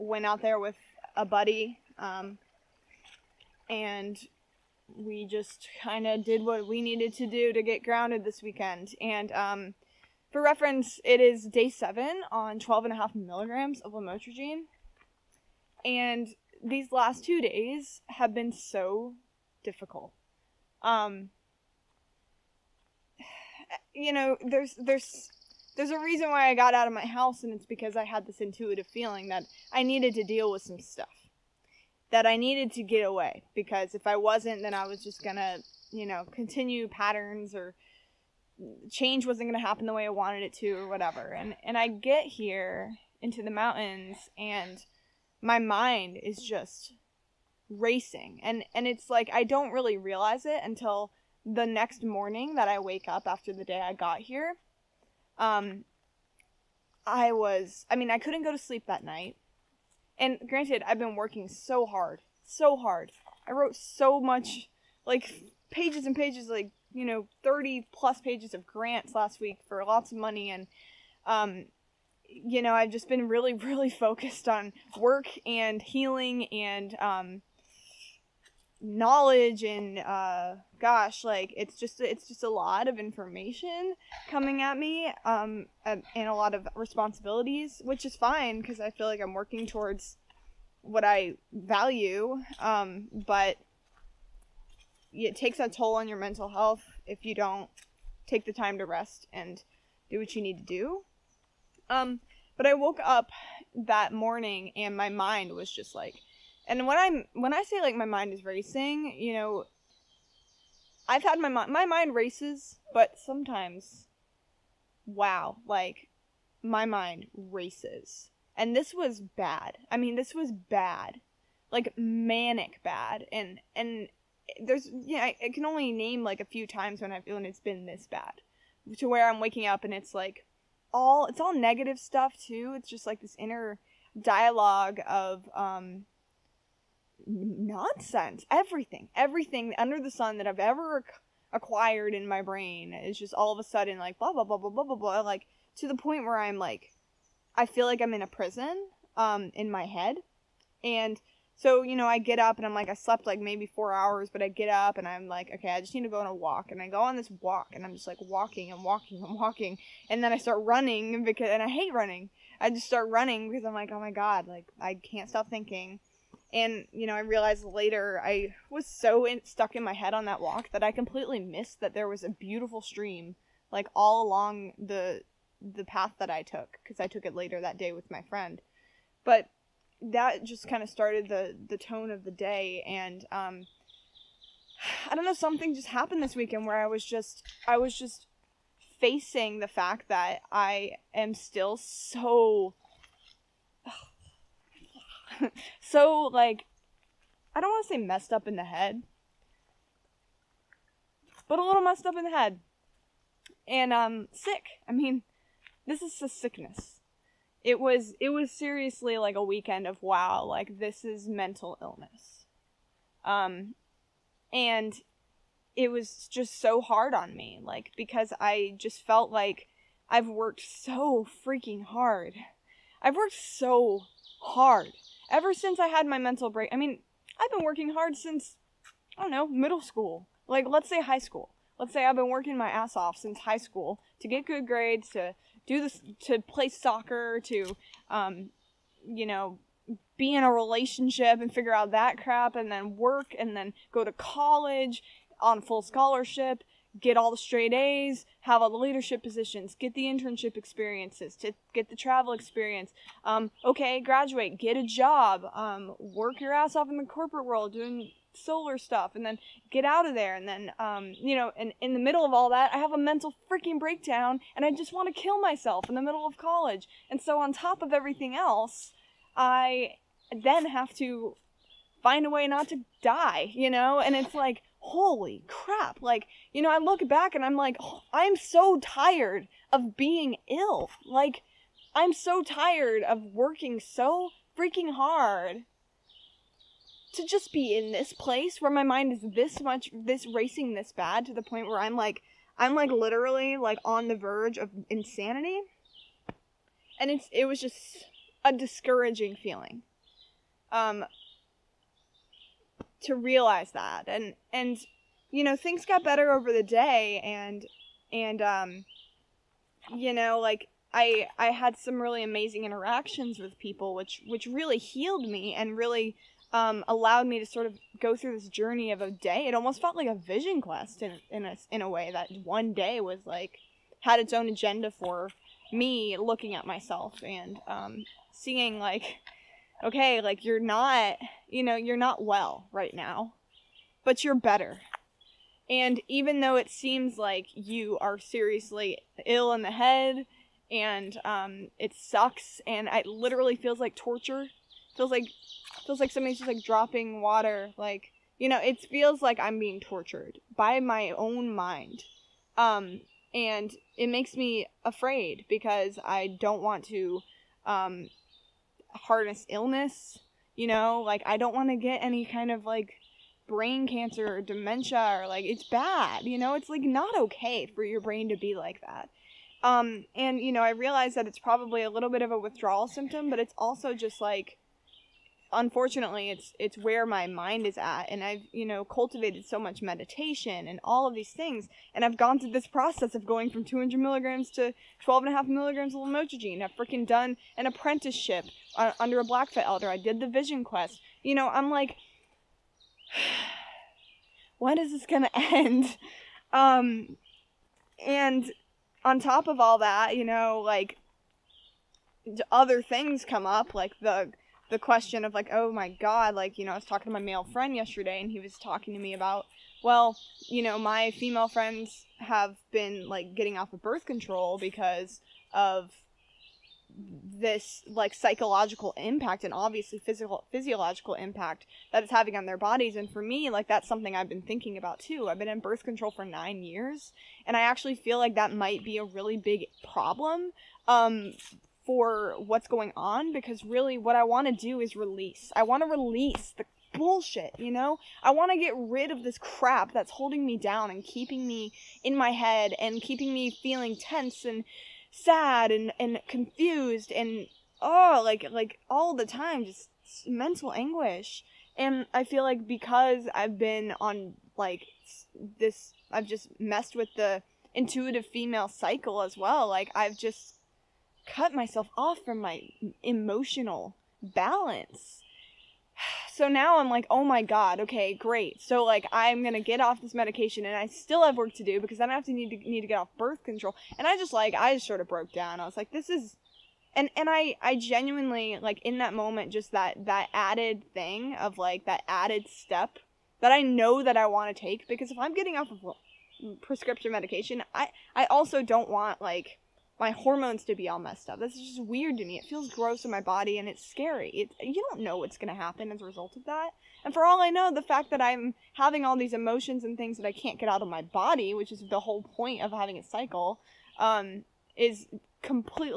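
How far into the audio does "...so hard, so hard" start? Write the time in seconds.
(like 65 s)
61 s.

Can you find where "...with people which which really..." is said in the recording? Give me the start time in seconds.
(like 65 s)
313 s.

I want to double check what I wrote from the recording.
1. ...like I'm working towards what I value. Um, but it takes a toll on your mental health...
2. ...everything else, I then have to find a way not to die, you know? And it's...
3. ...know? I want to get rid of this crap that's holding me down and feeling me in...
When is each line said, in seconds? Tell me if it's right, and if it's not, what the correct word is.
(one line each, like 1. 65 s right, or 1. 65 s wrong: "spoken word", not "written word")
1. 89 s right
2. 267 s right
3. 437 s wrong: "keeping", not "feeling".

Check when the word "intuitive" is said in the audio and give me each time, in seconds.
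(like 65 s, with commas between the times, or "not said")
28 s, 457 s.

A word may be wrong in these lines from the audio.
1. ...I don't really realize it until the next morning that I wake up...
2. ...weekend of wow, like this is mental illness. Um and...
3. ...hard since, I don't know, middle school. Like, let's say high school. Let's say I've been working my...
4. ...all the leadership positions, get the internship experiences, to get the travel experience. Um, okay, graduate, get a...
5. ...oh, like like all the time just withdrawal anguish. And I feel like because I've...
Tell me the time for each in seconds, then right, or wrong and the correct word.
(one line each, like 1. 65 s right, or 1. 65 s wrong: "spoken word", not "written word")
1. 49 s right
2. 209 s right
3. 227 s right
4. 248 s right
5. 447 s wrong: "mental", not "withdrawal".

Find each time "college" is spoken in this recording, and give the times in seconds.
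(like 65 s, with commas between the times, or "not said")
244 s, 266 s.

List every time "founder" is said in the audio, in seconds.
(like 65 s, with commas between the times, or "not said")
not said.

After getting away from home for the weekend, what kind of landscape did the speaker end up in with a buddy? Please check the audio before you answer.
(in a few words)
the mountains.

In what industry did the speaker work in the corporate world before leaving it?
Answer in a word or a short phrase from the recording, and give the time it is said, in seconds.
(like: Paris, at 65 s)
solar, at 258 s.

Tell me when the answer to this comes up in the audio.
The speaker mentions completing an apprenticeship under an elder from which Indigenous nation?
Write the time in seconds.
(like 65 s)
389 s.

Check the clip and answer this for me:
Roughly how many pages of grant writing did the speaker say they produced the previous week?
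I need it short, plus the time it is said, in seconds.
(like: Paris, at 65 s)
30, at 67 s.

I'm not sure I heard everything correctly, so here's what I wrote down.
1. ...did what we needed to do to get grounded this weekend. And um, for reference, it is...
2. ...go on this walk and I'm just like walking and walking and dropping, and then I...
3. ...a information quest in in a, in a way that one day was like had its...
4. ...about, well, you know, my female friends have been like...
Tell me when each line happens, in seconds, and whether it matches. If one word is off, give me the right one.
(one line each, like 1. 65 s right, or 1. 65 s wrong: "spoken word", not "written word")
1. 6 s right
2. 156 s wrong: "walking", not "dropping"
3. 320 s wrong: "vision", not "information"
4. 409 s right.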